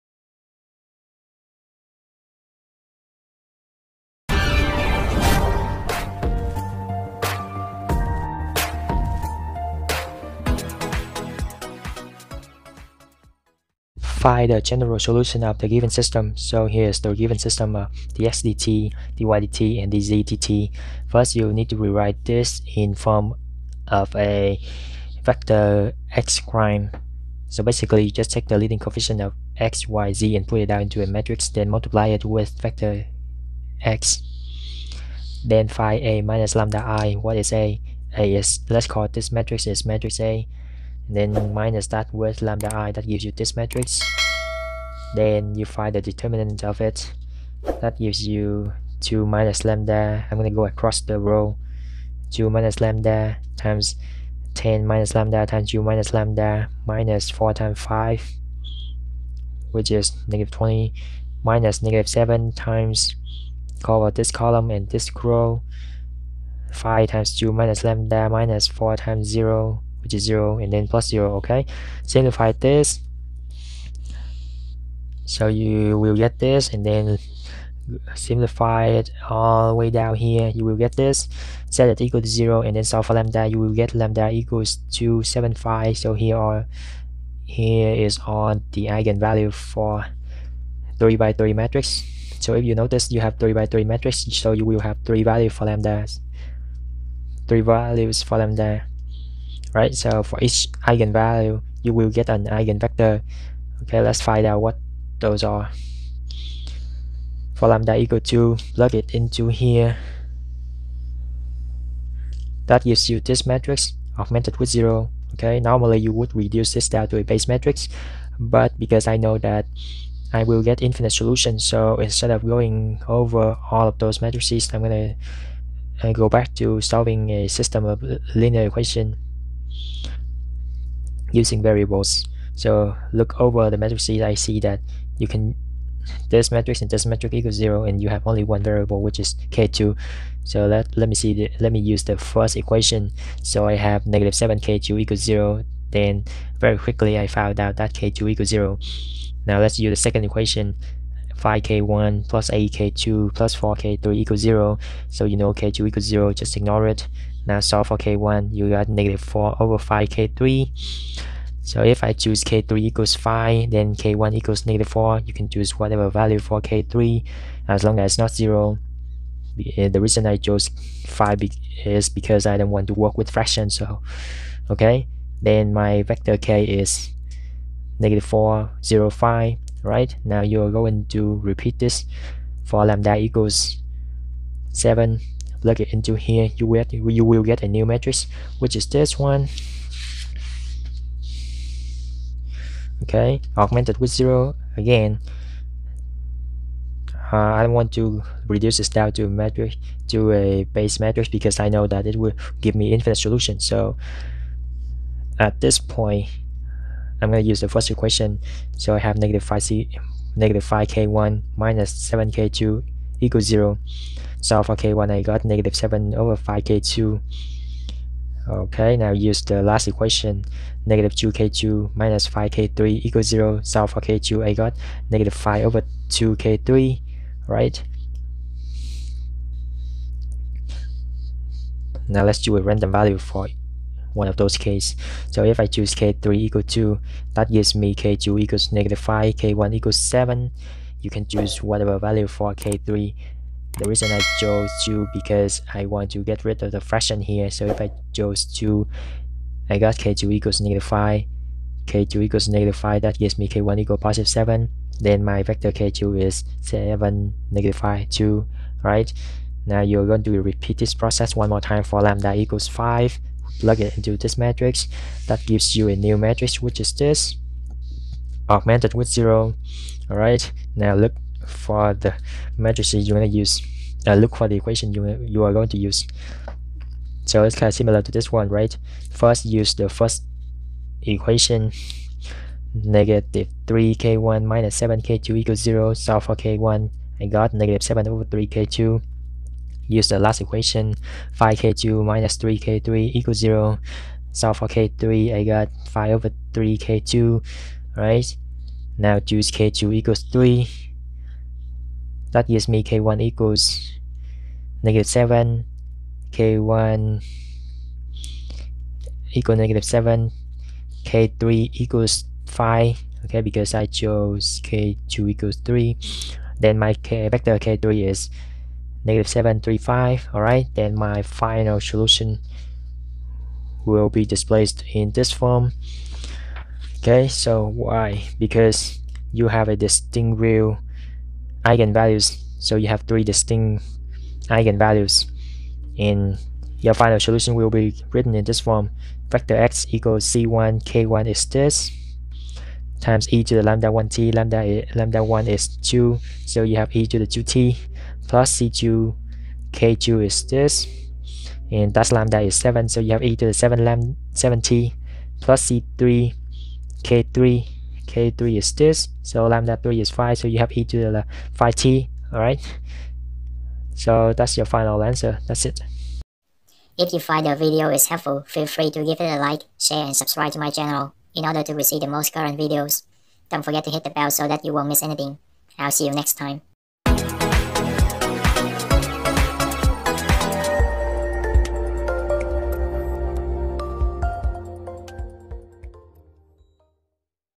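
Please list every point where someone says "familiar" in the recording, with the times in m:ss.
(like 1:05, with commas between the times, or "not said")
not said.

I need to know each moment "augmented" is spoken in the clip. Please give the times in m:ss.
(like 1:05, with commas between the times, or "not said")
1:54, 3:13, 4:28.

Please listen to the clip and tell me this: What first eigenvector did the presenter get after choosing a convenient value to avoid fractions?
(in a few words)
-4, 0, 5.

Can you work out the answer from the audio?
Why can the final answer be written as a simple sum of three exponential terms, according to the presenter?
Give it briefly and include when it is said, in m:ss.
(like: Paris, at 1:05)
distinct real eigenvalues, at 5:29.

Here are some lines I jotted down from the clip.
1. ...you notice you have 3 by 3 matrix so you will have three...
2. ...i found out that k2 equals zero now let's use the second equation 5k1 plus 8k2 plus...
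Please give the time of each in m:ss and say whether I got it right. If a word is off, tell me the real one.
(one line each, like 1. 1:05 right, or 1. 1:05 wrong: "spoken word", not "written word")
1. 1:32 right
2. 2:27 right.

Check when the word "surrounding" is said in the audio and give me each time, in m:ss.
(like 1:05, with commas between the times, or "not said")
not said.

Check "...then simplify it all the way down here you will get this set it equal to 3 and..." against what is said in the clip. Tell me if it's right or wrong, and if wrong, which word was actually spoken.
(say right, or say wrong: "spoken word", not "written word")
wrong: "0", not "3".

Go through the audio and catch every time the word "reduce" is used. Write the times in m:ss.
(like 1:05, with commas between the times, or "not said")
1:56, 3:18.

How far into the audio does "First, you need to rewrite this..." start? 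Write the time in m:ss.
0:21.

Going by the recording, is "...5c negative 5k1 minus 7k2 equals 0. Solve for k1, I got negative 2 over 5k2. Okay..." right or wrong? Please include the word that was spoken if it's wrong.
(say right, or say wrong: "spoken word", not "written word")
wrong: "7", not "2".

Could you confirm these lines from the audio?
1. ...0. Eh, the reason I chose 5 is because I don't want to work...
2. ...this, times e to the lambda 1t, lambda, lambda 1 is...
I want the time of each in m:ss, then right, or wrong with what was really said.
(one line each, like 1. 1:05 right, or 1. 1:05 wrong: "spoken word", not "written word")
1. 2:48 right
2. 5:41 right.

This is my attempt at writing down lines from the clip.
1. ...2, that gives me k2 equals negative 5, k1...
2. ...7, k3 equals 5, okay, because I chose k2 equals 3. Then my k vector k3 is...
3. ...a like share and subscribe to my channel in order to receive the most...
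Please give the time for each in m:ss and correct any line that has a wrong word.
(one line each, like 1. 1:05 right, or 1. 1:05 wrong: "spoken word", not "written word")
1. 3:56 right
2. 5:09 right
3. 6:09 right.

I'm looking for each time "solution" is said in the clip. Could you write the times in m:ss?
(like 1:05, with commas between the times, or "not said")
0:14, 2:01, 3:23, 5:21, 5:37.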